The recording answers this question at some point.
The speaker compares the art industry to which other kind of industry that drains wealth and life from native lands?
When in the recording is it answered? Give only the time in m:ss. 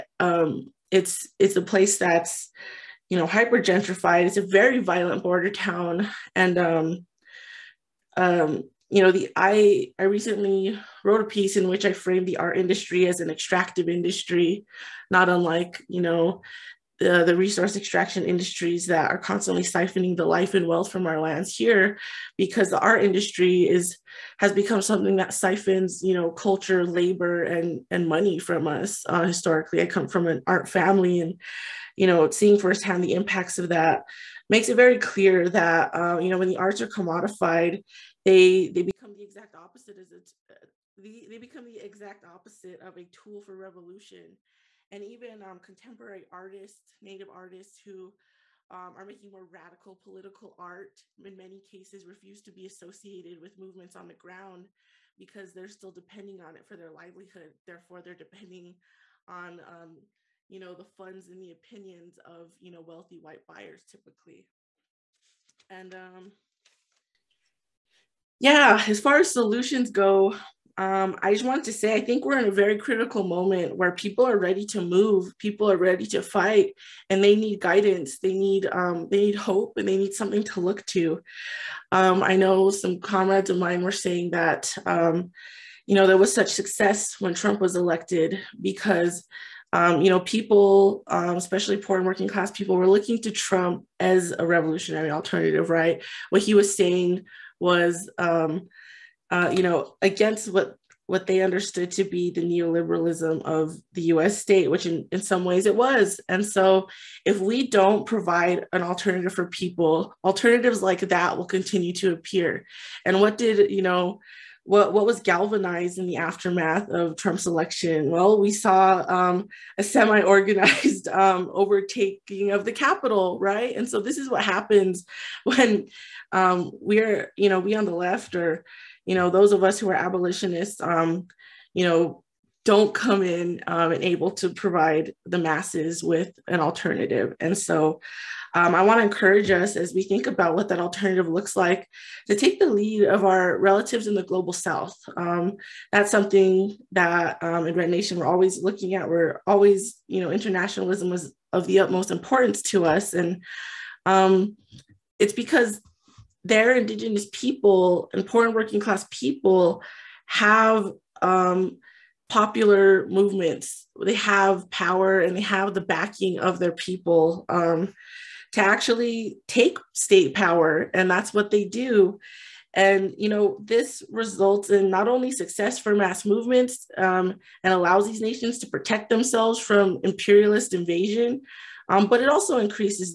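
0:17.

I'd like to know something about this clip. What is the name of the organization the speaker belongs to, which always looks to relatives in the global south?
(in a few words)
Red Nation.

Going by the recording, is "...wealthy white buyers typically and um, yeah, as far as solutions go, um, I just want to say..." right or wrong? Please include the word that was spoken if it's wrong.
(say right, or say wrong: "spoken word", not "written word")
right.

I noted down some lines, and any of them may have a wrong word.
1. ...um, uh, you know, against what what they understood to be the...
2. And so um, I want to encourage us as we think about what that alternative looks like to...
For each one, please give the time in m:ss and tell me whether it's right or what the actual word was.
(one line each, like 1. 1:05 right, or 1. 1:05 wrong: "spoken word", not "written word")
1. 1:38 right
2. 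2:17 right.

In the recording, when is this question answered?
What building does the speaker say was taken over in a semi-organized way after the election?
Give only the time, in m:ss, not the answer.
2:02.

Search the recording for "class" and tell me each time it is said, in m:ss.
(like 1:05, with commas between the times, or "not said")
1:32, 2:38.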